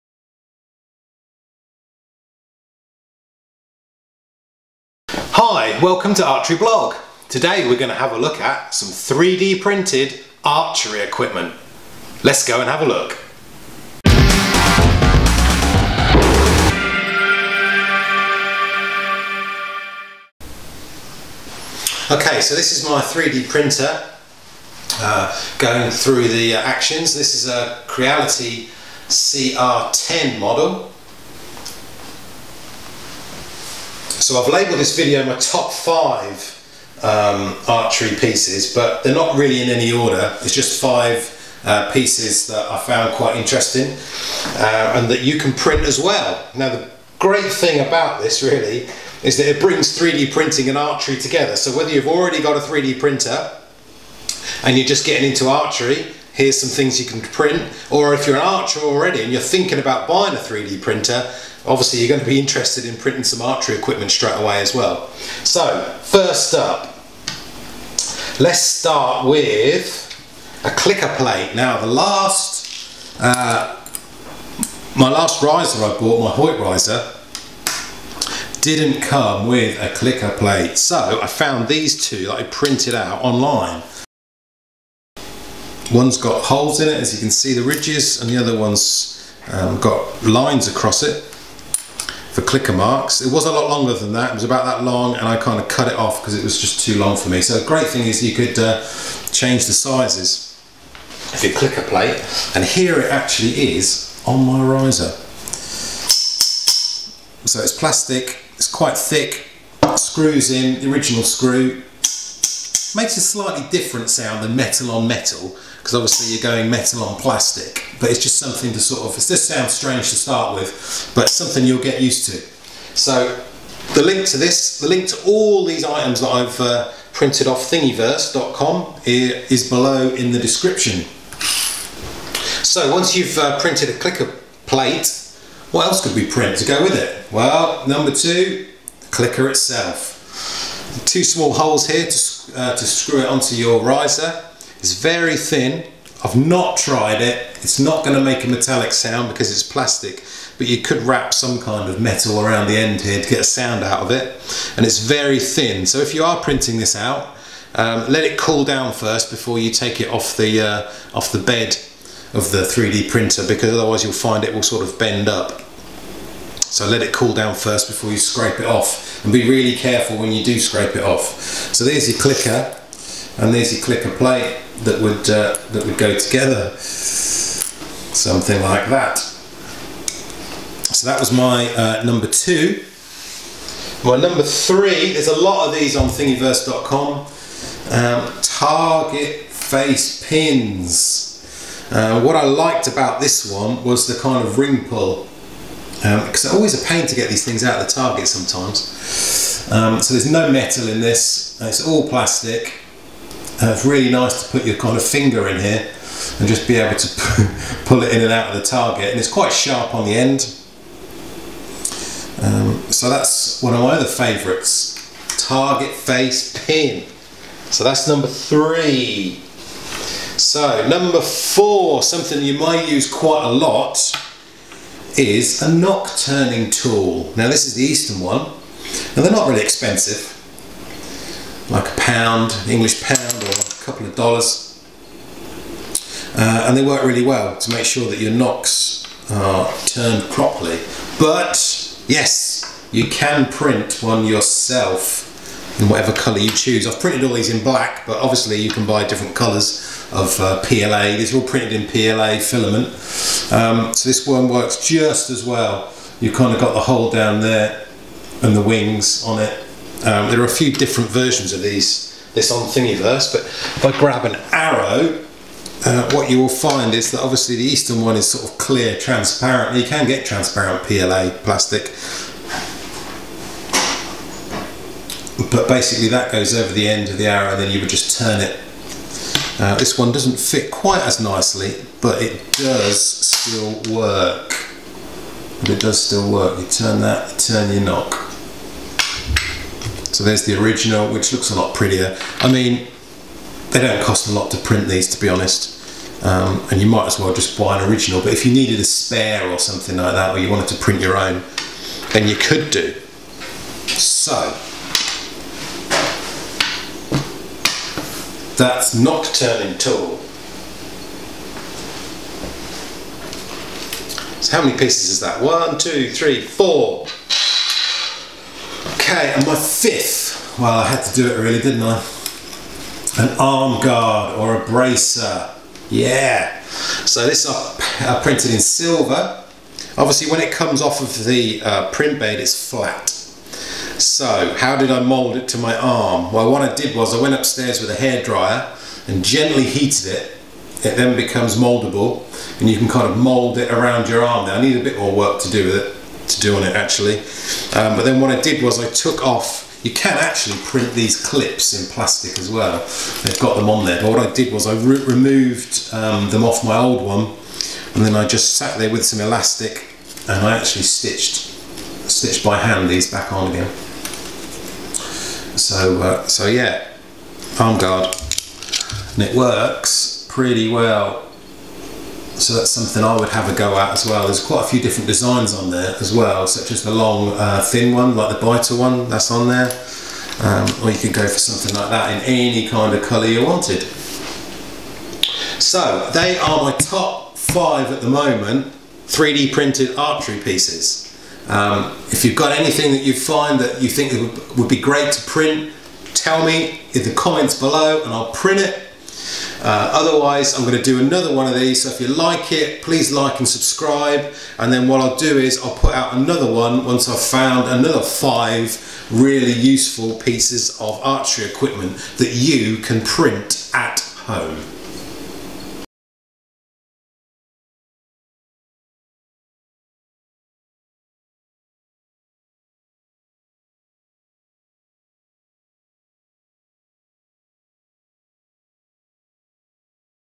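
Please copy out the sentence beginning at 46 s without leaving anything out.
Now the great thing about this really is that it brings 3D printing and archery together.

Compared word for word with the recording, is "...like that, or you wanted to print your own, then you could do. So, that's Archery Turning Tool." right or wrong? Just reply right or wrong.
wrong.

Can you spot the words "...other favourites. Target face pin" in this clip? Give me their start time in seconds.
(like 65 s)
213 s.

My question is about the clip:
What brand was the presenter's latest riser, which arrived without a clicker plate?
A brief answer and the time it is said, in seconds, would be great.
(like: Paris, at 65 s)
Hoyt, at 76 s.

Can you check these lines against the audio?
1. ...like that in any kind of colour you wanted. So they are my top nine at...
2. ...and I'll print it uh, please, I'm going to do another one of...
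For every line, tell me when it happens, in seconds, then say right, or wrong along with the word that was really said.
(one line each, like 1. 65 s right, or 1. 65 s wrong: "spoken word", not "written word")
1. 381 s wrong: "five", not "nine"
2. 398 s wrong: "otherwise", not "please".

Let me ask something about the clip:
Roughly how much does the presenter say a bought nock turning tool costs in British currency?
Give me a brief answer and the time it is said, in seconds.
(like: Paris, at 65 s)
a pound, at 231 s.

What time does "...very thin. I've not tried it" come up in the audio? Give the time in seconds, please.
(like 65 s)
144 s.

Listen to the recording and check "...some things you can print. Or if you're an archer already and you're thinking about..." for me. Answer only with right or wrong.
right.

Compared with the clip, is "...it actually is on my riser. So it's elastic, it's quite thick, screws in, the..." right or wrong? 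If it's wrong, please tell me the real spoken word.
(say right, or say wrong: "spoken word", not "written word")
wrong: "plastic", not "elastic".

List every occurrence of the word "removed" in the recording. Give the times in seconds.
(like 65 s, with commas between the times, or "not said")
355 s.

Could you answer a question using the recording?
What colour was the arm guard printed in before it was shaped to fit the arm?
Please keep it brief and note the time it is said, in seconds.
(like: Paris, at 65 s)
silver, at 328 s.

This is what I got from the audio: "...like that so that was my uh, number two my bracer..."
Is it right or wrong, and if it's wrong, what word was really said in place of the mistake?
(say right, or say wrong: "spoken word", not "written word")
wrong: "number", not "bracer".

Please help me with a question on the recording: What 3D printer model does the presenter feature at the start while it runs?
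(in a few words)
Creality CR10.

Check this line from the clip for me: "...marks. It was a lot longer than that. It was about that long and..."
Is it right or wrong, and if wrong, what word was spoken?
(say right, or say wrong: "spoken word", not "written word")
right.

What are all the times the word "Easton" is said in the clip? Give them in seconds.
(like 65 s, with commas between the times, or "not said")
227 s, 267 s.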